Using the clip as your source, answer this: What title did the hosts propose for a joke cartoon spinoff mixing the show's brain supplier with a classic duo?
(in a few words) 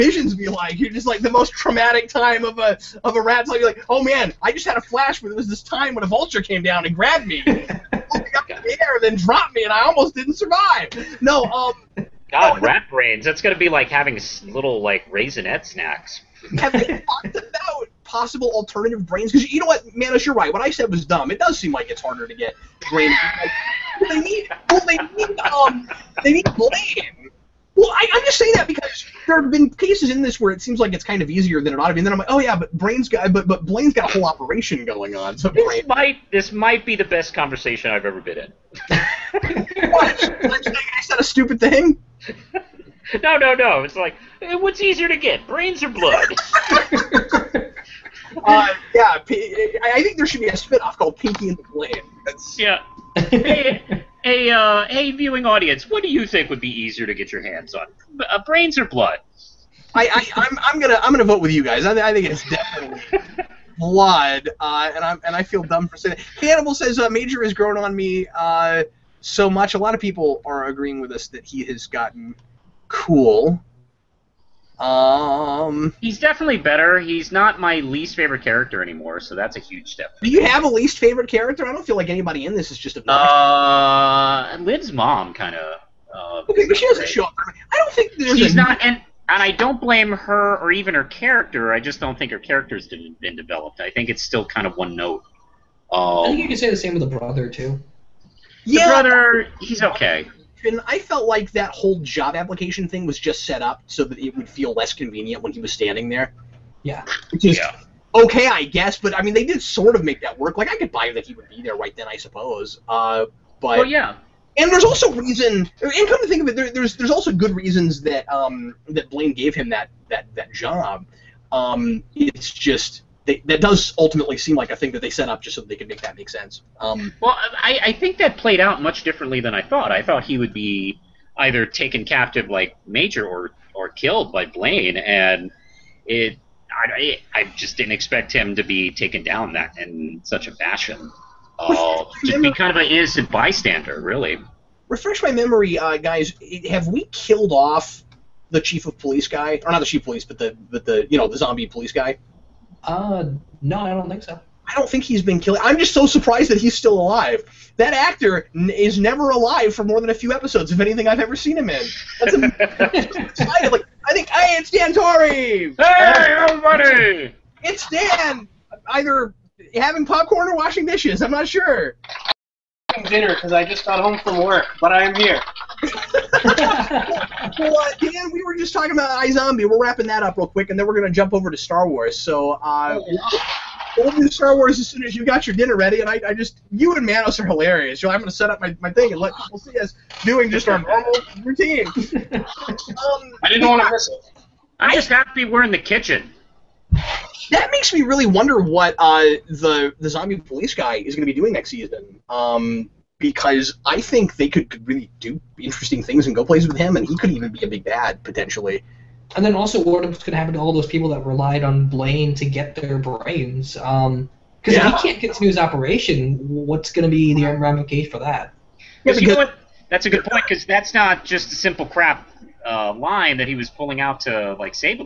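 Pinky and the Blade.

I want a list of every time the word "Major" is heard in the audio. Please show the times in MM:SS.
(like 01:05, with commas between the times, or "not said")
01:07, 02:12.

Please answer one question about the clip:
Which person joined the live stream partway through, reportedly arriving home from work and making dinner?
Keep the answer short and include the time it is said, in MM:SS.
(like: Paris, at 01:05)
Dan Torrey, at 02:44.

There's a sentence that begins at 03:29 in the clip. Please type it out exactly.
And then also, what could happen to all those people that relied on Blaine to get their brains?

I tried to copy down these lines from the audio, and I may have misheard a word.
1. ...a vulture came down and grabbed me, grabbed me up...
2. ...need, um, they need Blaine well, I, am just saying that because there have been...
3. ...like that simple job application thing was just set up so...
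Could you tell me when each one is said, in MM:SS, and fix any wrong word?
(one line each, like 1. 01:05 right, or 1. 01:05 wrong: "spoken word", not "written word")
1. 00:06 wrong: "pulled", not "grabbed"
2. 00:24 right
3. 01:41 wrong: "whole", not "simple".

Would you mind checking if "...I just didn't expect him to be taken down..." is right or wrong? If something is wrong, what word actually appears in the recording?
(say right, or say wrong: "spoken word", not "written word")
right.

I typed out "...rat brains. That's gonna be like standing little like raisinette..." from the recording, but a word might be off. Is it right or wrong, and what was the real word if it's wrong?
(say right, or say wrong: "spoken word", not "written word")
wrong: "having", not "standing".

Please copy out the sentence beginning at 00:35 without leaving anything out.
So this might this might be the best conversation I've ever been in.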